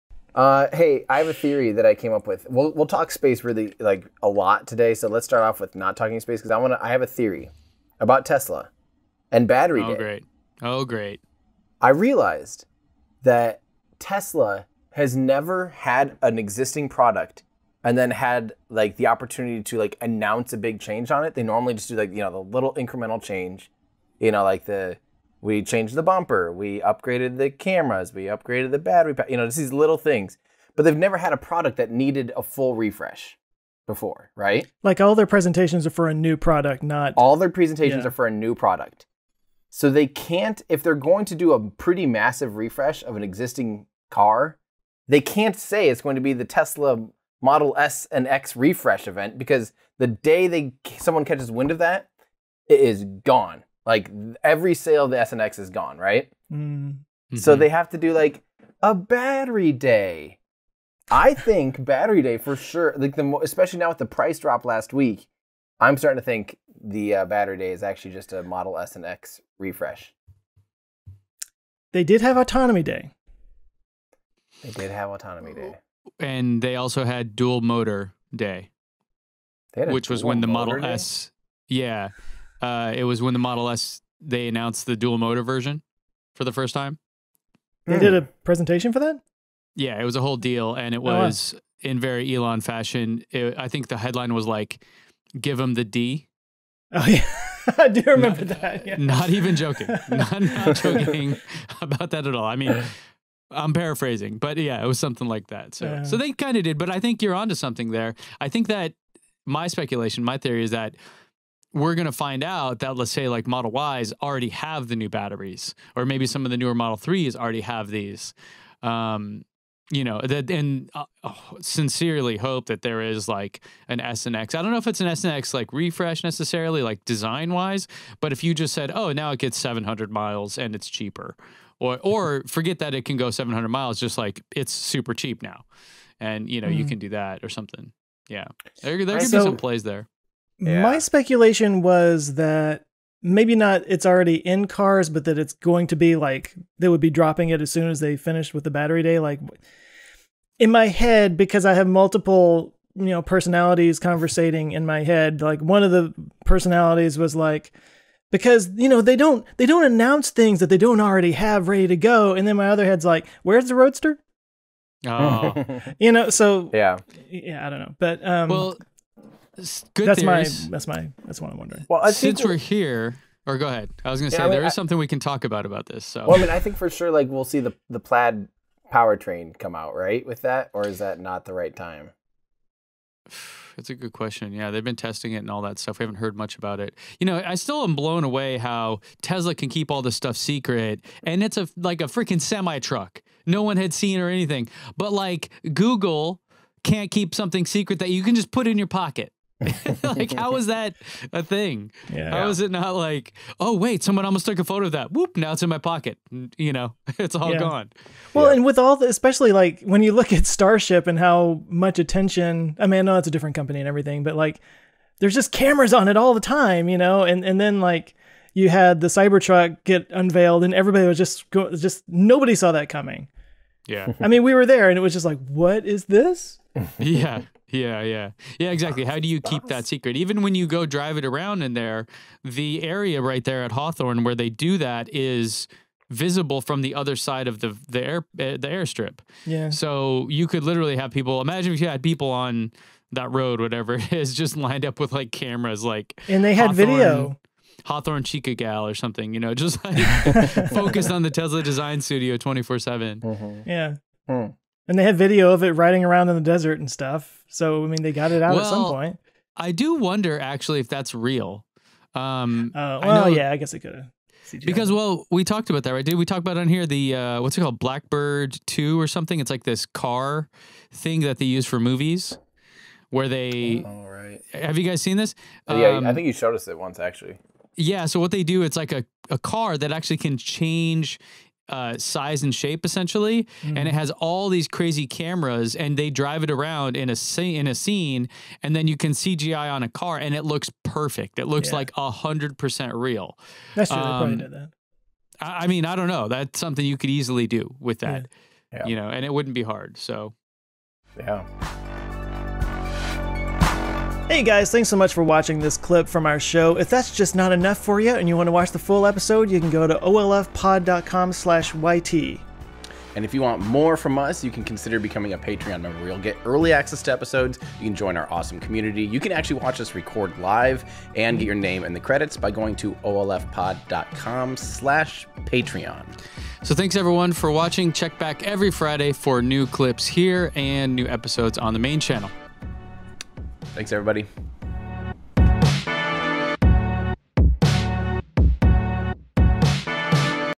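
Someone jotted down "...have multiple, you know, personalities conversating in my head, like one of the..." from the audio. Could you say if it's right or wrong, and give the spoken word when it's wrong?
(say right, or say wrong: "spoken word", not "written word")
right.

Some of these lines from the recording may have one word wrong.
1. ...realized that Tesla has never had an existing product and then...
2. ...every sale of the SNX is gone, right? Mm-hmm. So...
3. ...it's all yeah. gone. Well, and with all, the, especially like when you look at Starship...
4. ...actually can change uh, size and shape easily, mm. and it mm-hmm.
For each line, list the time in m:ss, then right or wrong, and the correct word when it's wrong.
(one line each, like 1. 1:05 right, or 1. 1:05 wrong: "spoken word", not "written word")
1. 0:11 right
2. 0:54 right
3. 3:27 right
4. 4:39 wrong: "essentially", not "easily".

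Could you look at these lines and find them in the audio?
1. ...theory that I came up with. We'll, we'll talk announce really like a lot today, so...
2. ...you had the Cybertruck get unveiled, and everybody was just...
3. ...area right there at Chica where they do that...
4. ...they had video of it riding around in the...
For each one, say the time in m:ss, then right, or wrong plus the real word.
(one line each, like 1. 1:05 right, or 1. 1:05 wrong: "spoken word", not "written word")
1. 0:01 wrong: "space", not "announce"
2. 3:38 right
3. 3:52 wrong: "Hawthorne", not "Chica"
4. 4:14 right.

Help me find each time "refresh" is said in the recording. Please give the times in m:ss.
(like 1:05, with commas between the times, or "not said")
0:32, 0:42, 0:48, 1:09, 2:05.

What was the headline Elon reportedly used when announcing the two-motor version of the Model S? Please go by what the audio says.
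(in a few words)
Give them the D.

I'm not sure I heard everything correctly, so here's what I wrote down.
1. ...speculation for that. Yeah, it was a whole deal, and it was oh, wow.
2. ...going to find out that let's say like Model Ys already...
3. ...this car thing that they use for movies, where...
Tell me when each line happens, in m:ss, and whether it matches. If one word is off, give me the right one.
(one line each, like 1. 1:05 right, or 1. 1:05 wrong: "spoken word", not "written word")
1. 1:28 wrong: "presentation", not "speculation"
2. 1:51 right
3. 4:29 right.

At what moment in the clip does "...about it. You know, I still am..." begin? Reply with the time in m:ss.
3:06.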